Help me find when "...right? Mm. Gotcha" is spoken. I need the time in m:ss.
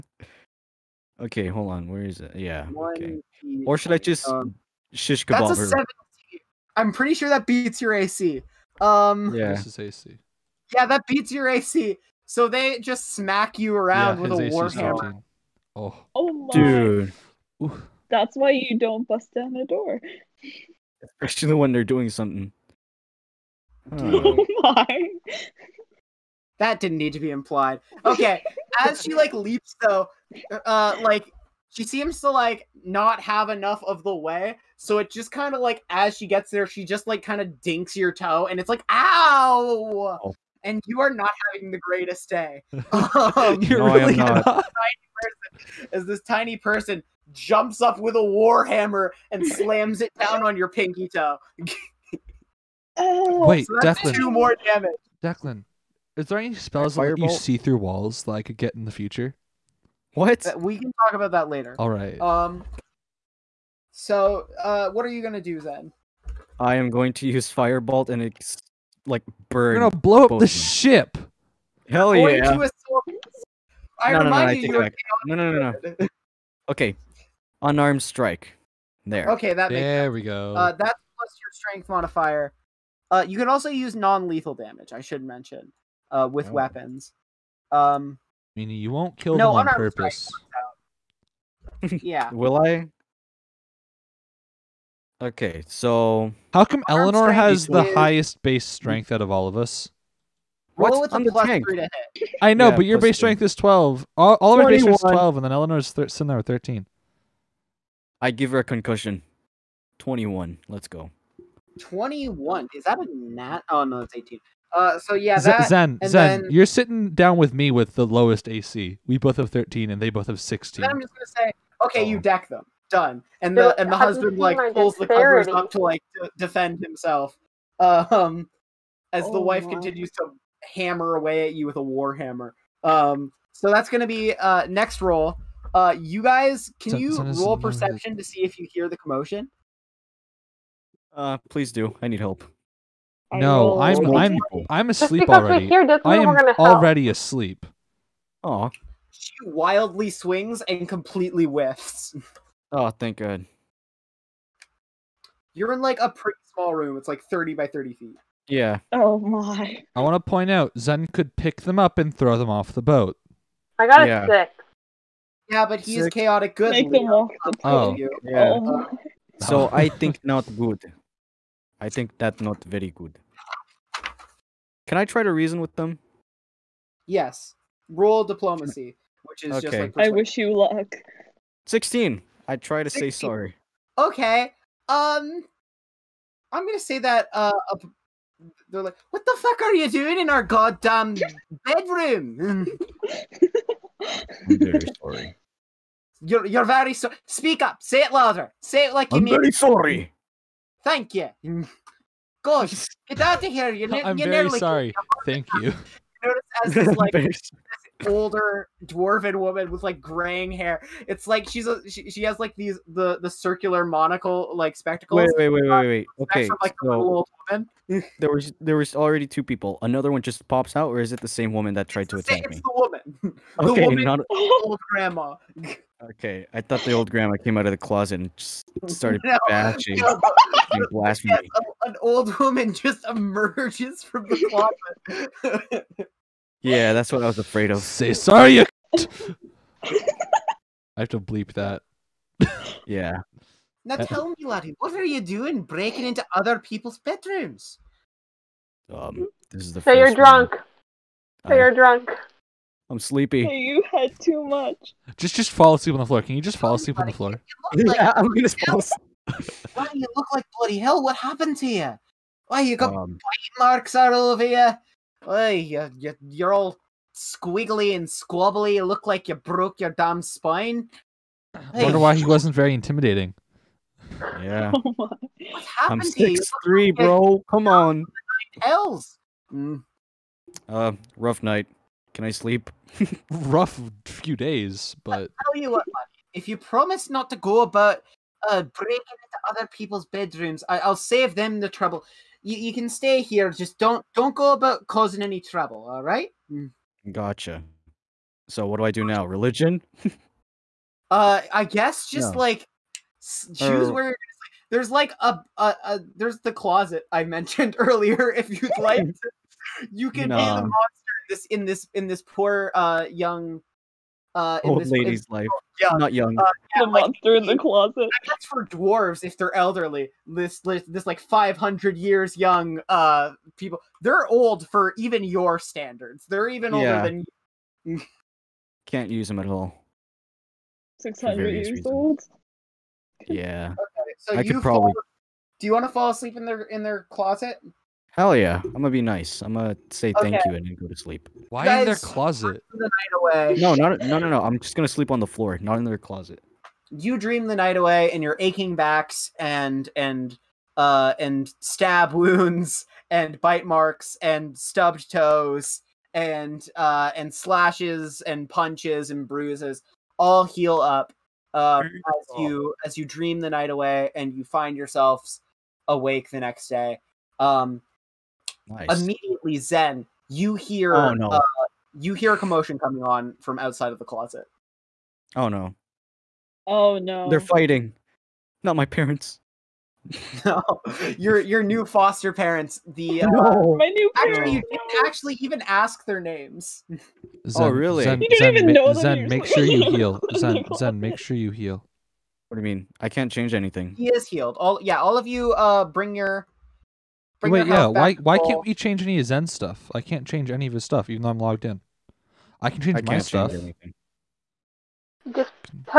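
4:56.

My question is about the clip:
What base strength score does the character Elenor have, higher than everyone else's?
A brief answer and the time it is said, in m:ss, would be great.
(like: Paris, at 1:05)
13, at 1:46.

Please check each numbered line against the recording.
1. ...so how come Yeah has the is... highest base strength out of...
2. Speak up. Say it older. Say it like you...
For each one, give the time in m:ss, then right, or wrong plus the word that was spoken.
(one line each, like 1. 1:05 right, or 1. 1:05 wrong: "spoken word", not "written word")
1. 1:35 wrong: "Elenor", not "Yeah"
2. 3:17 wrong: "louder", not "older".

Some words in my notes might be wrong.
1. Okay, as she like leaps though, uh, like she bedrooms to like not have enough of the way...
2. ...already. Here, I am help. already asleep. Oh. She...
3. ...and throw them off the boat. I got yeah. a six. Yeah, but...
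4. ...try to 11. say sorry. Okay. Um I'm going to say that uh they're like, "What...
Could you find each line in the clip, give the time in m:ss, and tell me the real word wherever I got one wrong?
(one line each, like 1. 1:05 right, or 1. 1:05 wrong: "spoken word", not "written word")
1. 0:28 wrong: "seems", not "bedrooms"
2. 2:25 right
3. 2:41 right
4. 3:02 wrong: "16", not "11".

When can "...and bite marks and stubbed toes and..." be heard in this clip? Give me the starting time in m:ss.
5:53.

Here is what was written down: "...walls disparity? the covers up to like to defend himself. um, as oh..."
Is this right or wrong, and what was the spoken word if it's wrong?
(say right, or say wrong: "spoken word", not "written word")
wrong: "pulls", not "walls".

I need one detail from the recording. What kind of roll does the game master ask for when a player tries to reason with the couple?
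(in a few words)
Diplomacy.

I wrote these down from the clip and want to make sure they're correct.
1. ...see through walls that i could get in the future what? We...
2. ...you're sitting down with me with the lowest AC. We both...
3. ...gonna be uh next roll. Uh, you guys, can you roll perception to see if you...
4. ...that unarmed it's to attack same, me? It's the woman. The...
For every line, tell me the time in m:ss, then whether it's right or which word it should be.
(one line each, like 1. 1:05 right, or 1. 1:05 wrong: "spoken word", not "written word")
1. 0:57 right
2. 1:56 right
3. 2:13 right
4. 3:41 wrong: "tried", not "unarmed".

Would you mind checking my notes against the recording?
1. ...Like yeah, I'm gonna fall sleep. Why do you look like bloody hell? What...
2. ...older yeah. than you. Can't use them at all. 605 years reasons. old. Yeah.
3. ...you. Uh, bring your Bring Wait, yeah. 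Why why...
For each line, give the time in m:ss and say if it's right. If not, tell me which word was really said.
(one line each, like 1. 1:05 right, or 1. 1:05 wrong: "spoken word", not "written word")
1. 4:17 wrong: "asleep", not "sleep"
2. 5:26 wrong: "600", not "605"
3. 6:35 right.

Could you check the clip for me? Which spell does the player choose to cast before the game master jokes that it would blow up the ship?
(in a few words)
Firebolt.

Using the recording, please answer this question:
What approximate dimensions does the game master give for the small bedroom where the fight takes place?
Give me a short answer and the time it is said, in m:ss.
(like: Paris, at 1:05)
30 by 30 feet, at 2:37.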